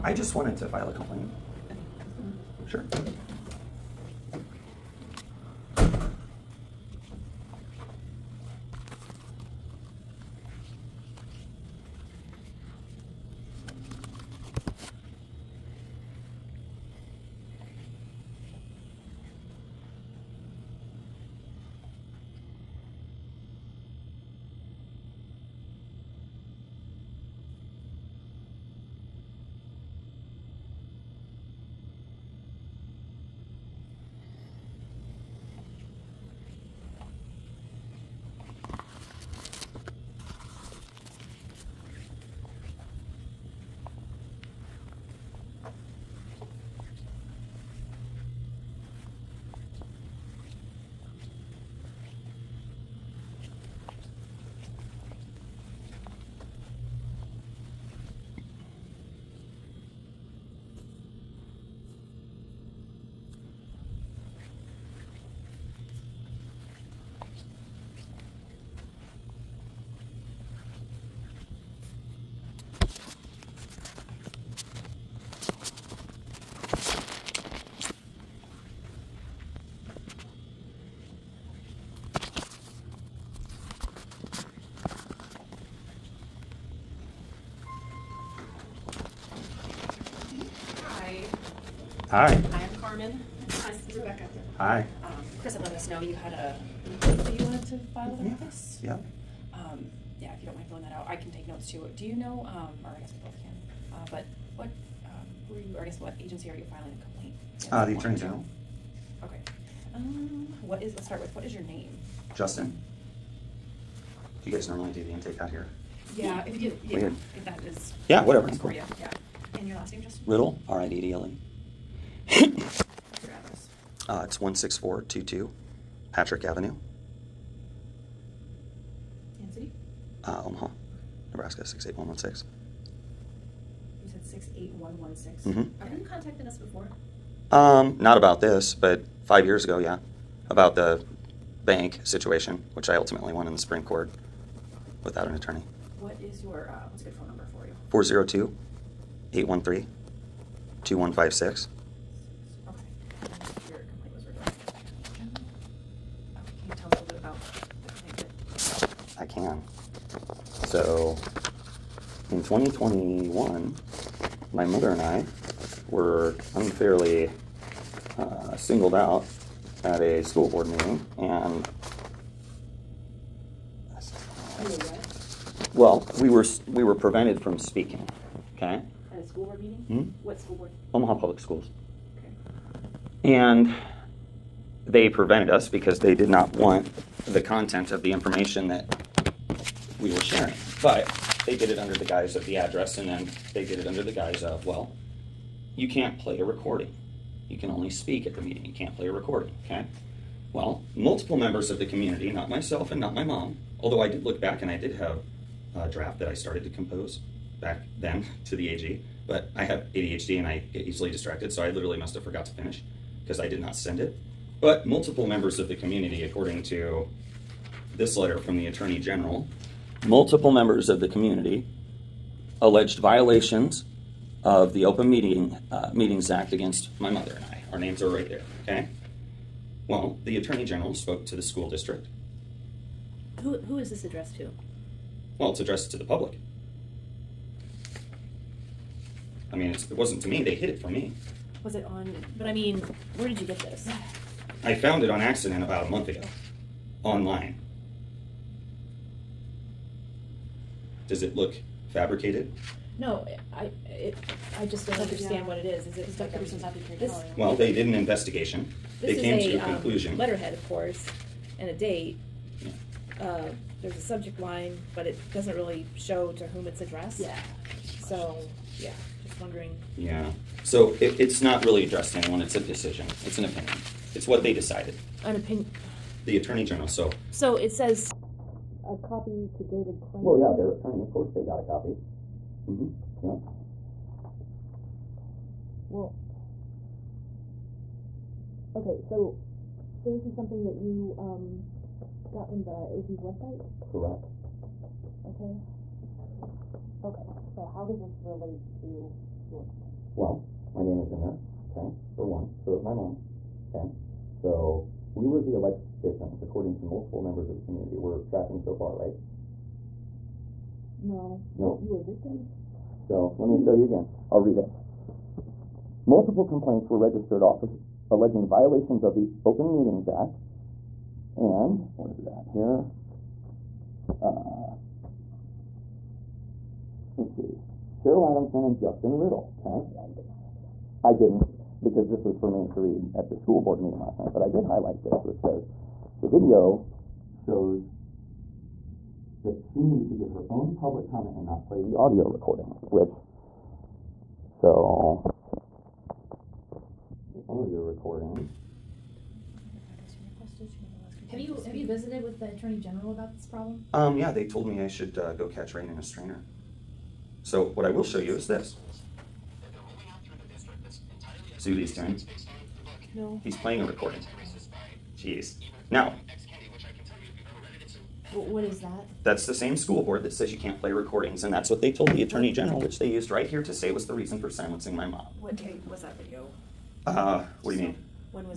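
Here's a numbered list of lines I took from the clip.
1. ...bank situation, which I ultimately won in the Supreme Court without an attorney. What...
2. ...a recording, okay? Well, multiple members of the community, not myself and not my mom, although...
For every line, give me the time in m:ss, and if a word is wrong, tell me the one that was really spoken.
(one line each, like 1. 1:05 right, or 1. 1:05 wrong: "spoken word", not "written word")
1. 2:21 right
2. 3:19 right.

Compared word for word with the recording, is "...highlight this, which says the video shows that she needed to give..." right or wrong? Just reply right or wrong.
right.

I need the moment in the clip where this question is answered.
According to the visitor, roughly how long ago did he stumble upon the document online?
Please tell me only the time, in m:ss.
4:05.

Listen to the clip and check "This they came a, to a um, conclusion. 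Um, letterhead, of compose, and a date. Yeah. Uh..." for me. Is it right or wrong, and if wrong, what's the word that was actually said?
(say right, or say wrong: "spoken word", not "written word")
wrong: "course", not "compose".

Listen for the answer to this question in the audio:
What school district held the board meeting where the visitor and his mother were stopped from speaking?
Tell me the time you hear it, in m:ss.
3:00.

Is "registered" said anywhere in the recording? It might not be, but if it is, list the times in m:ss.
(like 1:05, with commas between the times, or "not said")
5:16.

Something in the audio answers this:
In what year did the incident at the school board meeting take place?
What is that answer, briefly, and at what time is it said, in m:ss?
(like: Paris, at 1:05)
2021, at 2:42.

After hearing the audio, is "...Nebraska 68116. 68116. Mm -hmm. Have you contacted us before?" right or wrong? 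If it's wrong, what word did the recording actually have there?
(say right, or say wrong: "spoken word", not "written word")
right.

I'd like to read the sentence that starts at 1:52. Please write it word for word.
Justin you guys normally do the intake out here?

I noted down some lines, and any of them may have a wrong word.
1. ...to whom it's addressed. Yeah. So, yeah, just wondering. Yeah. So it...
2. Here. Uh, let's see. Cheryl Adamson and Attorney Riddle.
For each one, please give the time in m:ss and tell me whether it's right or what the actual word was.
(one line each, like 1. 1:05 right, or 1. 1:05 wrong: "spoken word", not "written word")
1. 4:26 right
2. 5:22 wrong: "Justin", not "Attorney".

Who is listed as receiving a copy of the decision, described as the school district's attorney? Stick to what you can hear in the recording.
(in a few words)
David Crane.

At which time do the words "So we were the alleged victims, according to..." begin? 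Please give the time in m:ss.
5:04.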